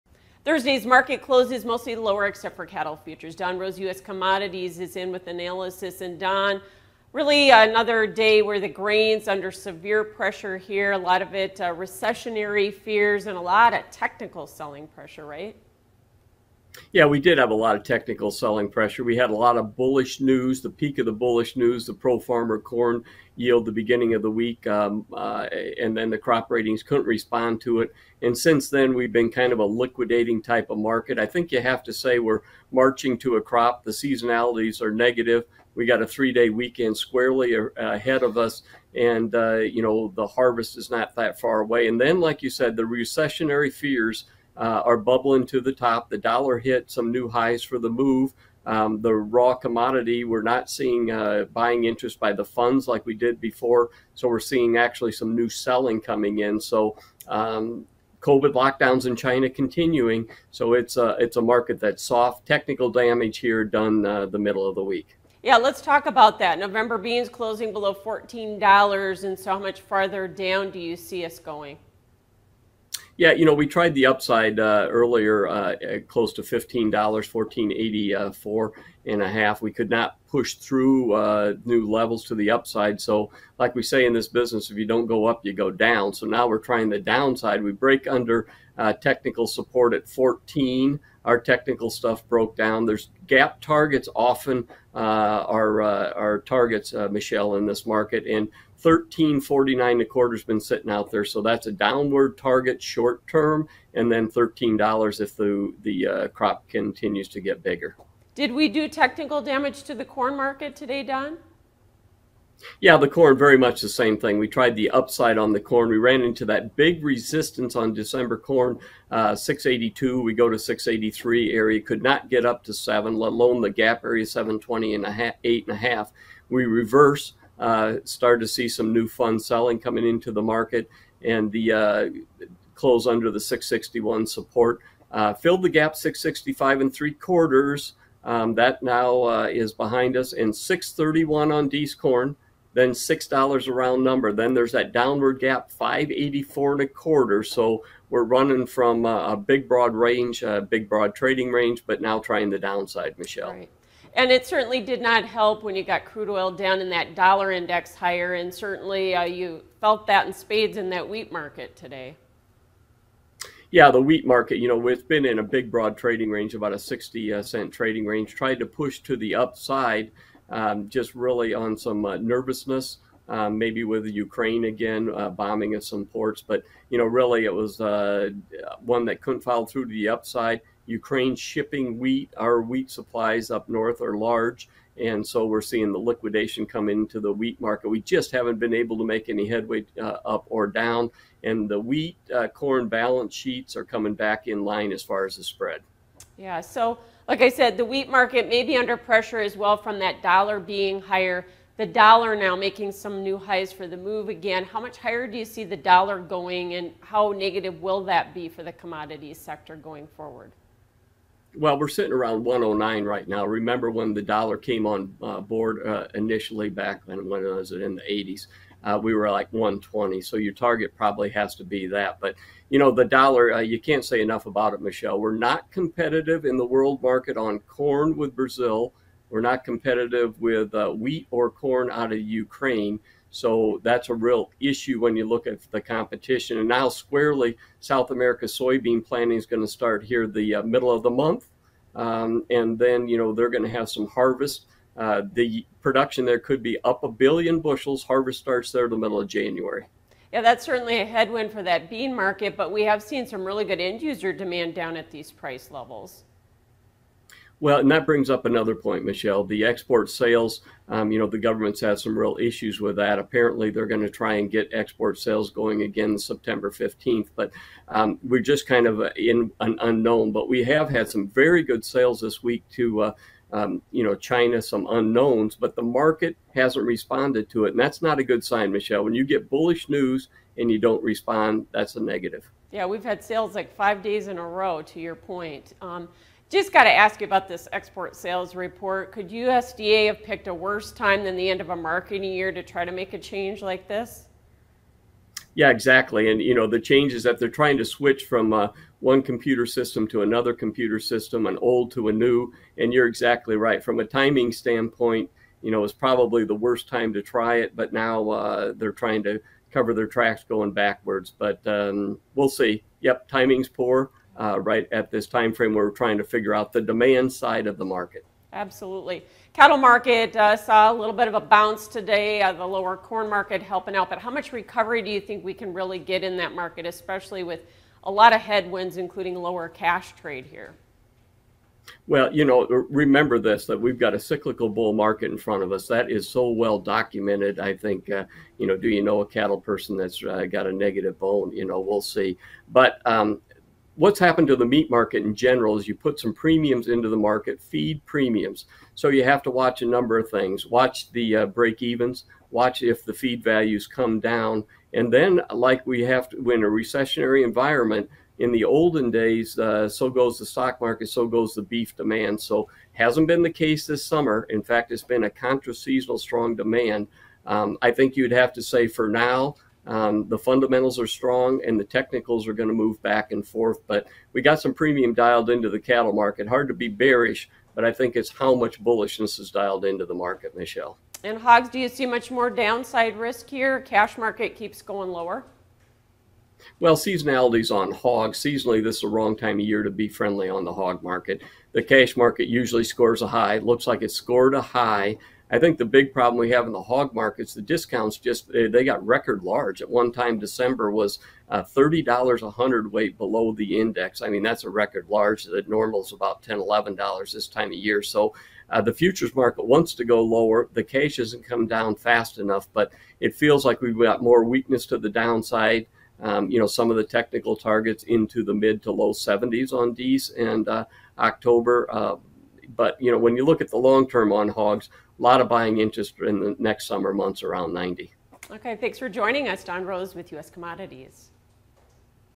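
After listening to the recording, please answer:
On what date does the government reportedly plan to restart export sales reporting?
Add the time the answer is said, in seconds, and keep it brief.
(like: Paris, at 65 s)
September 15, at 266 s.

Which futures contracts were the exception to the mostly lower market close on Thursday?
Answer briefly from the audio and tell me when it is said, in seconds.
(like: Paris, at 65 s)
Cattle futures, at 2 s.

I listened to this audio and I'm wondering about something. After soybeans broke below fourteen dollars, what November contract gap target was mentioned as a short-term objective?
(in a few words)
13.49 1/4.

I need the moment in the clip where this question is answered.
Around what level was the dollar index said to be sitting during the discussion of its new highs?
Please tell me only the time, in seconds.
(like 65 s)
212 s.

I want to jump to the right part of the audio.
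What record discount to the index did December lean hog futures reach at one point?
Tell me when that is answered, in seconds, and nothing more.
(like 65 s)
401 s.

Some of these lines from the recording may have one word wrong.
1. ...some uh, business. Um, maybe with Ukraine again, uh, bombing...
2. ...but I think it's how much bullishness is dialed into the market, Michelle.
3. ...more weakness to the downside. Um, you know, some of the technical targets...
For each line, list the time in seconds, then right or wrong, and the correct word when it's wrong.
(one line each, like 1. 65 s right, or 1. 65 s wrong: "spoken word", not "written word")
1. 171 s wrong: "nervousness", not "business"
2. 377 s right
3. 414 s right.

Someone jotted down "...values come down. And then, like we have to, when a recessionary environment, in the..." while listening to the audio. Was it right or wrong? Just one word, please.
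right.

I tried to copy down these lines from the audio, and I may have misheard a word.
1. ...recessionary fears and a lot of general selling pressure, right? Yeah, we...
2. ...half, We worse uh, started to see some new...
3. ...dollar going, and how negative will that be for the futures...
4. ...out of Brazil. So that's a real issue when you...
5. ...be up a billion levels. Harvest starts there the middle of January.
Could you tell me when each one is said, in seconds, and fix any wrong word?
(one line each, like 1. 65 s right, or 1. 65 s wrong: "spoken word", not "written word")
1. 11 s wrong: "technical", not "general"
2. 125 s wrong: "reverse", not "worse"
3. 205 s wrong: "commodities", not "futures"
4. 231 s wrong: "Ukraine", not "Brazil"
5. 246 s wrong: "bushels", not "levels".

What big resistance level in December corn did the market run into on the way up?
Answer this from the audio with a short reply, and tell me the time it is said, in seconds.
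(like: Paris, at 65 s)
682, at 119 s.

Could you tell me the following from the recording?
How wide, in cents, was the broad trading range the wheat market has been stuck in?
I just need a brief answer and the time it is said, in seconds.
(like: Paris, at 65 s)
About 60 cents, at 166 s.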